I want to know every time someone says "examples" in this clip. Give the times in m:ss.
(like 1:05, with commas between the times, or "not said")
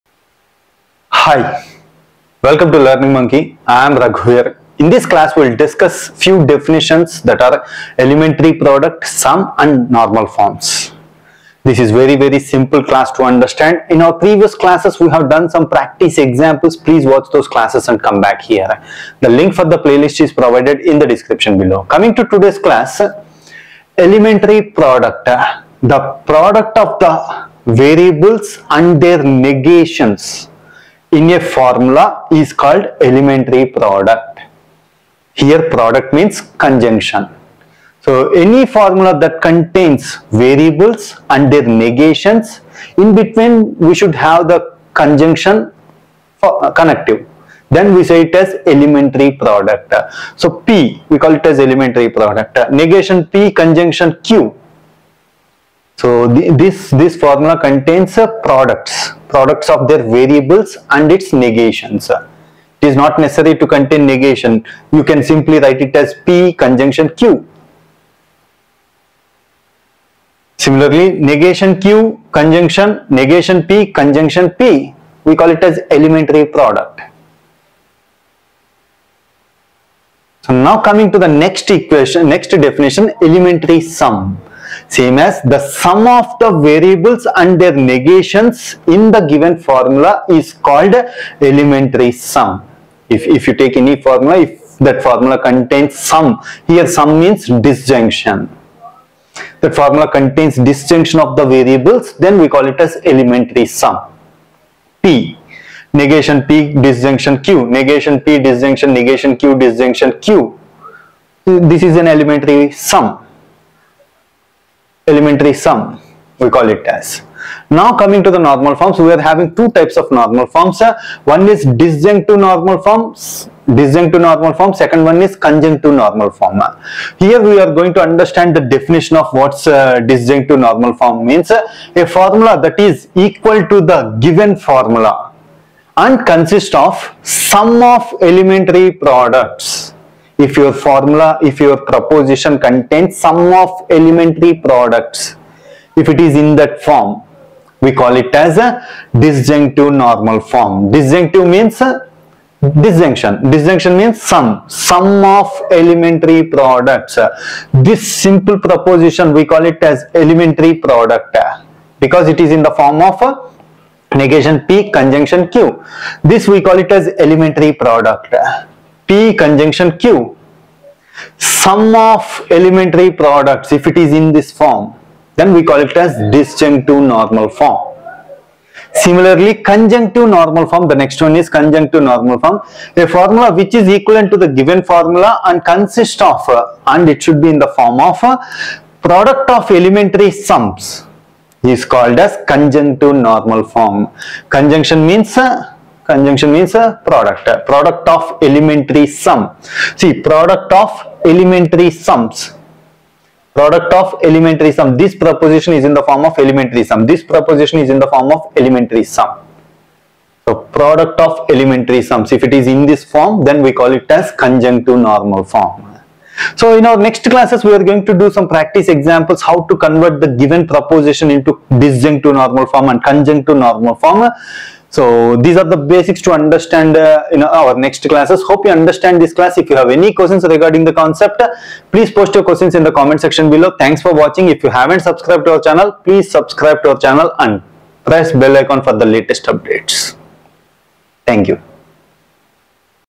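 0:16, 3:38.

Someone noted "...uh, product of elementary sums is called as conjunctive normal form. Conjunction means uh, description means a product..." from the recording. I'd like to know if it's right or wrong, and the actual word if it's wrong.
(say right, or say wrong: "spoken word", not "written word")
wrong: "conjunction", not "description".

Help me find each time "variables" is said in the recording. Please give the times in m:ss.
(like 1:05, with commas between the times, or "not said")
0:27, 0:40, 1:00, 1:26, 1:41.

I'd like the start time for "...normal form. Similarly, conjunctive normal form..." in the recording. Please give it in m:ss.
2:57.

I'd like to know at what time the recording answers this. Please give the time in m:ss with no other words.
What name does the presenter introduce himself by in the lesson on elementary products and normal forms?
0:03.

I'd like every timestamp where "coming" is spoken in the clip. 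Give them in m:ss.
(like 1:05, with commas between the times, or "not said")
0:21, 1:20, 1:57.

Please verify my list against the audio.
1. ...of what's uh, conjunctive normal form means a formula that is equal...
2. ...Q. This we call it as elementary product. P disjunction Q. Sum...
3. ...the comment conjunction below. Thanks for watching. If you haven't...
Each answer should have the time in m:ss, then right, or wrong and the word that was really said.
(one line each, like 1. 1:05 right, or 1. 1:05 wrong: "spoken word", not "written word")
1. 2:09 wrong: "disjunctive", not "conjunctive"
2. 2:45 wrong: "conjunction", not "disjunction"
3. 3:52 wrong: "section", not "conjunction".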